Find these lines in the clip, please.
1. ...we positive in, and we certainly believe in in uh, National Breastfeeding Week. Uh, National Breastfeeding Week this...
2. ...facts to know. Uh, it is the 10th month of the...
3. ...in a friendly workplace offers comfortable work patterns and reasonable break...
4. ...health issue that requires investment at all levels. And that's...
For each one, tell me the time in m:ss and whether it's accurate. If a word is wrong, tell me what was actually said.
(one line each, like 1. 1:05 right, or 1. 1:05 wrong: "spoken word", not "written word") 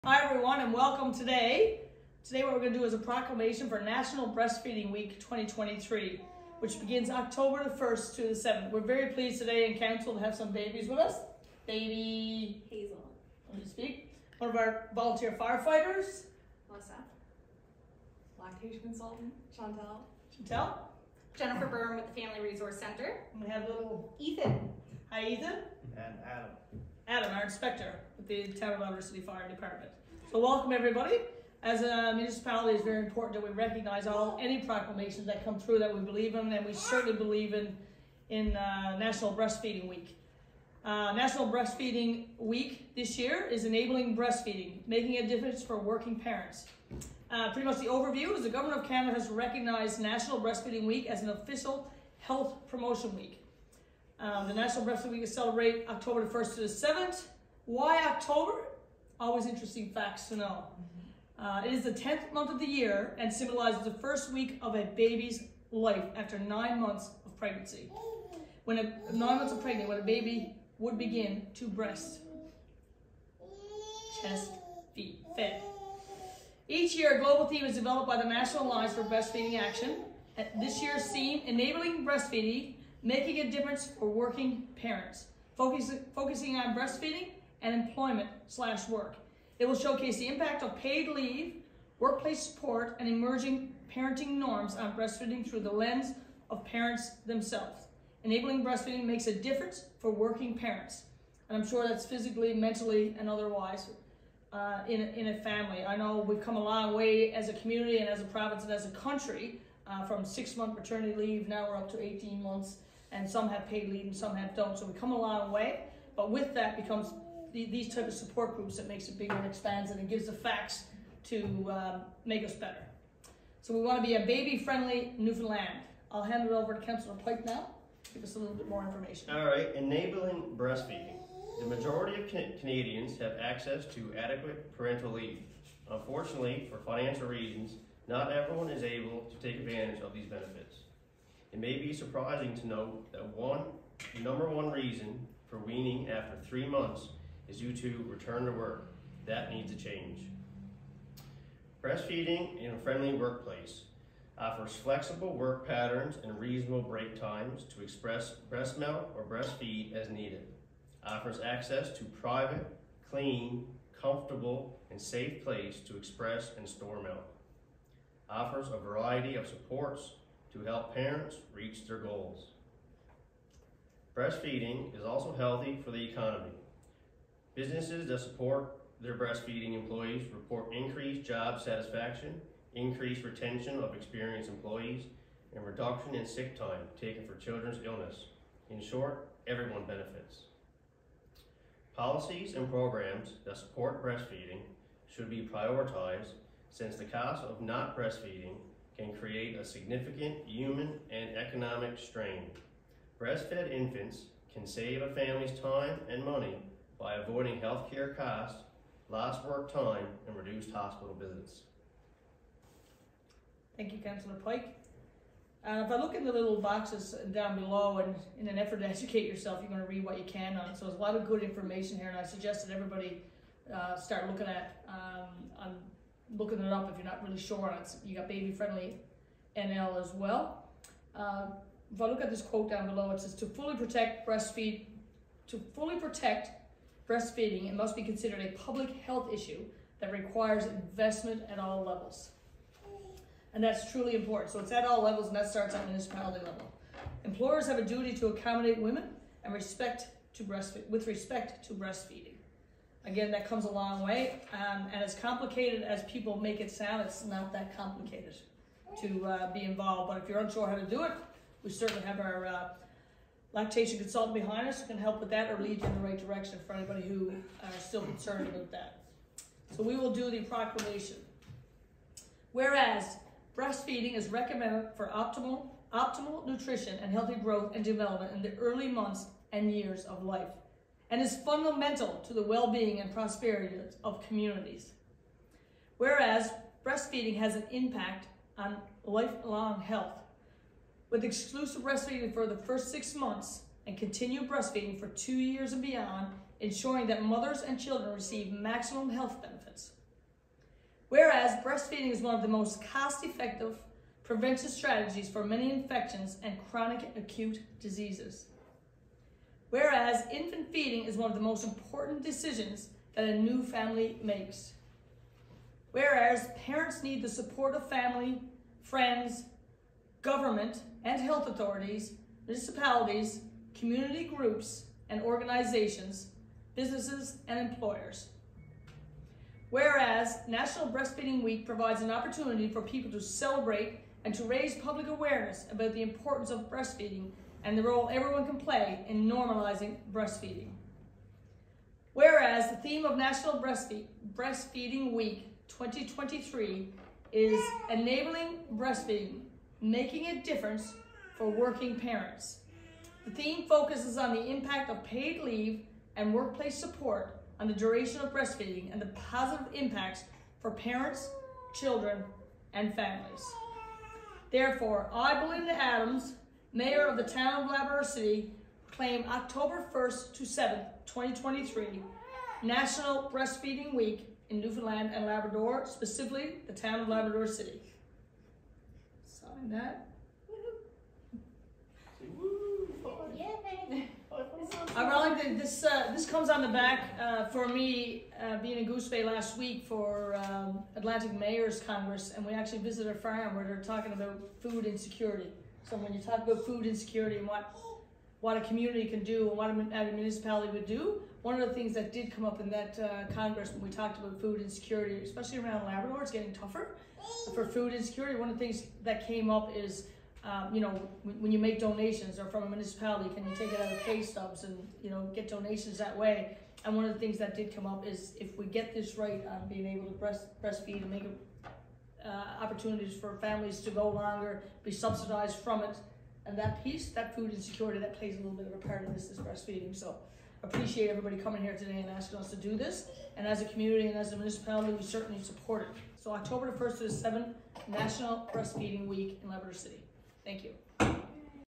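1. 0:35 wrong: "believe", not "positive"
2. 0:59 right
3. 2:32 wrong: "flexible", not "comfortable"
4. 3:59 right.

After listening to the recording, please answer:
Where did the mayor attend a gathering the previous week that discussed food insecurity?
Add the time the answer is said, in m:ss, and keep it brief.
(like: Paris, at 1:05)
Goose Bay, at 6:28.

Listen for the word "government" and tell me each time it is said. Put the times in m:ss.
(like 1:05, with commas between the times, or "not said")
0:48, 5:20.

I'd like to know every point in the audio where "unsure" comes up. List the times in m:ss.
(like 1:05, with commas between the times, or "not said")
4:20.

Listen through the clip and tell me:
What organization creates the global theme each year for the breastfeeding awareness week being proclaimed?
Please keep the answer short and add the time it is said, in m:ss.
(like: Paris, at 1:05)
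National Alliance for Breastfeeding Action, at 1:18.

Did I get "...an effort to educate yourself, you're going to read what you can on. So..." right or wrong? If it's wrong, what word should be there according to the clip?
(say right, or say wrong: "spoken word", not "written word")
right.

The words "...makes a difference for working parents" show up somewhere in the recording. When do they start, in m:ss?
1:39.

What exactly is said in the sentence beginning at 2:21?
It may be surprising to note that one number one reason for weaning after three months is due to return to work.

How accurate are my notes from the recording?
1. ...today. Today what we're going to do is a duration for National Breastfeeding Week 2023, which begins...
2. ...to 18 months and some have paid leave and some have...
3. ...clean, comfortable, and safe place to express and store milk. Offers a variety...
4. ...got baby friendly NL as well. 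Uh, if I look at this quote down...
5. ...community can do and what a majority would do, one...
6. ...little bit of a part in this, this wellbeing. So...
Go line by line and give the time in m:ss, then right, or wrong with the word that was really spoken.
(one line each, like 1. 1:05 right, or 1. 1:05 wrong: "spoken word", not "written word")
1. 0:01 wrong: "proclamation", not "duration"
2. 1:51 right
3. 2:43 right
4. 3:48 right
5. 6:38 wrong: "municipality", not "majority"
6. 7:08 wrong: "breastfeeding", not "wellbeing".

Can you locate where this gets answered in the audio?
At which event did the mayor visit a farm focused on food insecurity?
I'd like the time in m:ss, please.
6:30.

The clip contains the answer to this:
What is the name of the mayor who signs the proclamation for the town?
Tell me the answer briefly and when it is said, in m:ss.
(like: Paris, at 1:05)
Belinda Adams, at 6:05.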